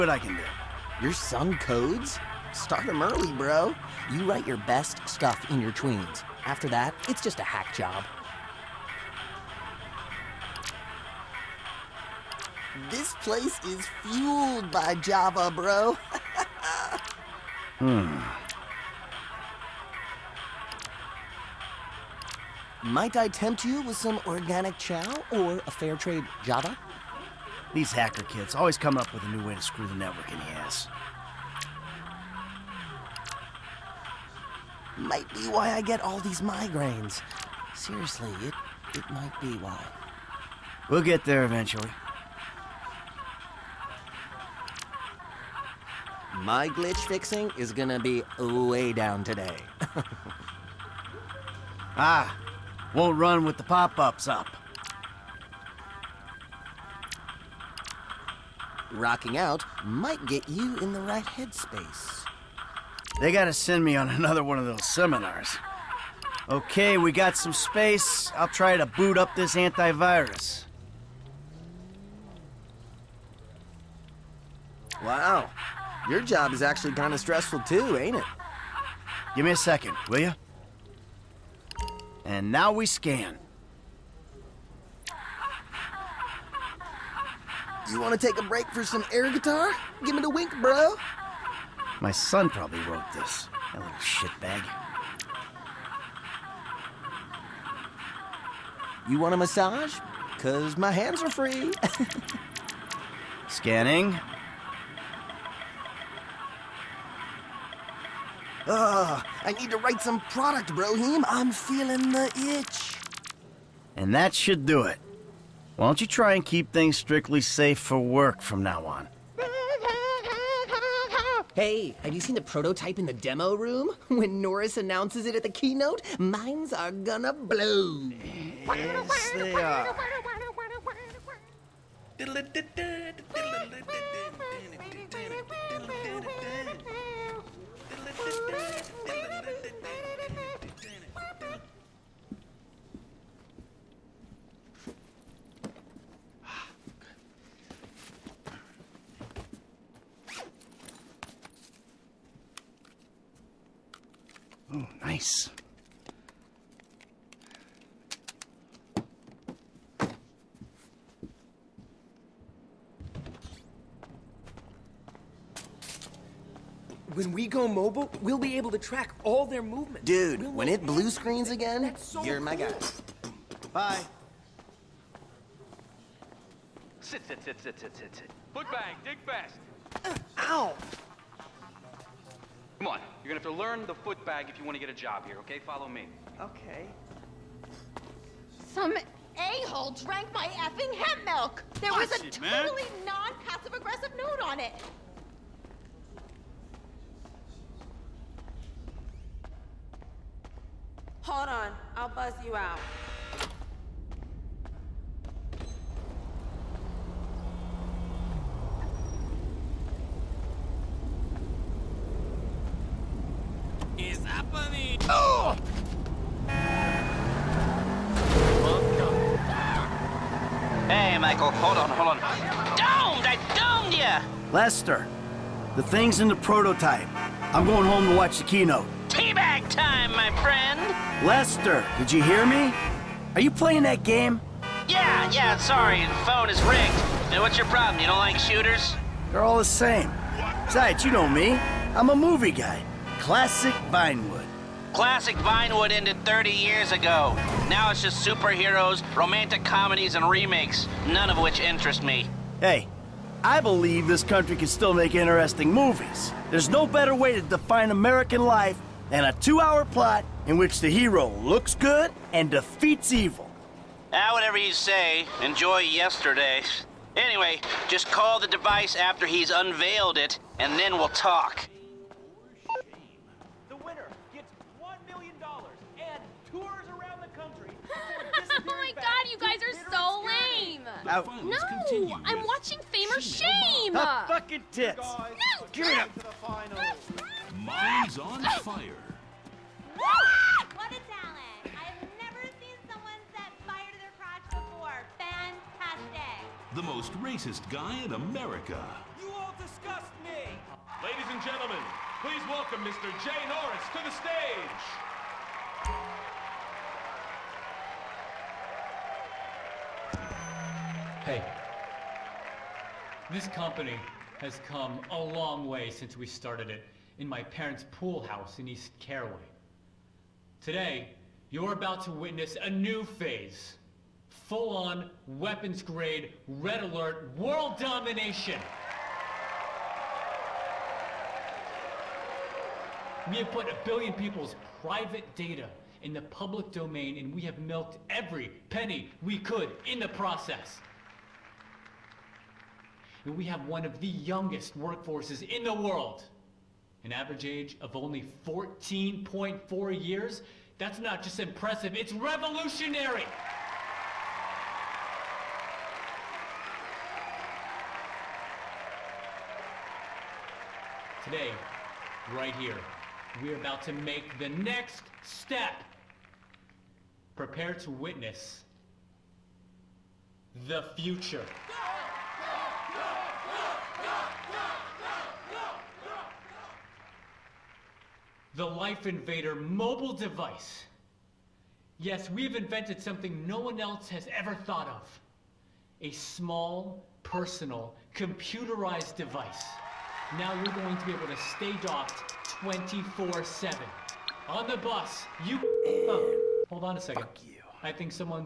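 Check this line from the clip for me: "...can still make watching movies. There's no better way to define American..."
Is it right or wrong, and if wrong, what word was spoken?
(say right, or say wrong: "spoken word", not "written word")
wrong: "interesting", not "watching".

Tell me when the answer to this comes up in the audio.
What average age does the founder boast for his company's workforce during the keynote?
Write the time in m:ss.
5:48.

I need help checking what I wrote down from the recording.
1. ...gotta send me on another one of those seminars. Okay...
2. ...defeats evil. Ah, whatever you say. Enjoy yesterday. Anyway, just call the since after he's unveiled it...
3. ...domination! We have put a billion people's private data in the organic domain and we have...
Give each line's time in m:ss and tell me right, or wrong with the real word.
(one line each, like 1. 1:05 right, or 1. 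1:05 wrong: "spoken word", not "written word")
1. 1:03 right
2. 4:22 wrong: "device", not "since"
3. 5:27 wrong: "public", not "organic".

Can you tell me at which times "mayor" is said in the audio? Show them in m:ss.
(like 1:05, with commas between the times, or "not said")
not said.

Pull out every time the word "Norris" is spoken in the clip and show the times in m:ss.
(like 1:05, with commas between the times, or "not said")
2:04, 5:03.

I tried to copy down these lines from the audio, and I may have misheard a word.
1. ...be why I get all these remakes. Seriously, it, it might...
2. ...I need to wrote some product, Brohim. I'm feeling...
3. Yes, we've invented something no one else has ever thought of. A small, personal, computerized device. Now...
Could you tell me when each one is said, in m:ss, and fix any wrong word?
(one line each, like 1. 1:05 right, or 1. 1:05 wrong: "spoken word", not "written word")
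1. 0:35 wrong: "migraines", not "remakes"
2. 1:49 wrong: "write", not "wrote"
3. 6:21 right.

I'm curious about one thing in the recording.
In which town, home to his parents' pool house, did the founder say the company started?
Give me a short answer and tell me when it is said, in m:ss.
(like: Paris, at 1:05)
East Caraway, at 5:18.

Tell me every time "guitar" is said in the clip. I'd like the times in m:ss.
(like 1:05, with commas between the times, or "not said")
1:29.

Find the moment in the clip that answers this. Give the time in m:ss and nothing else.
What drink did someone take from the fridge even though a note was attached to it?
3:10.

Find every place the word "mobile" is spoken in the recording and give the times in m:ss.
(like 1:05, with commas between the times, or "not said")
2:47, 6:19.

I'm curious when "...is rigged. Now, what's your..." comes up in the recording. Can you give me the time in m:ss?
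3:56.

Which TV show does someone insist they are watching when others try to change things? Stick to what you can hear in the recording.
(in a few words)
Fame or Shame.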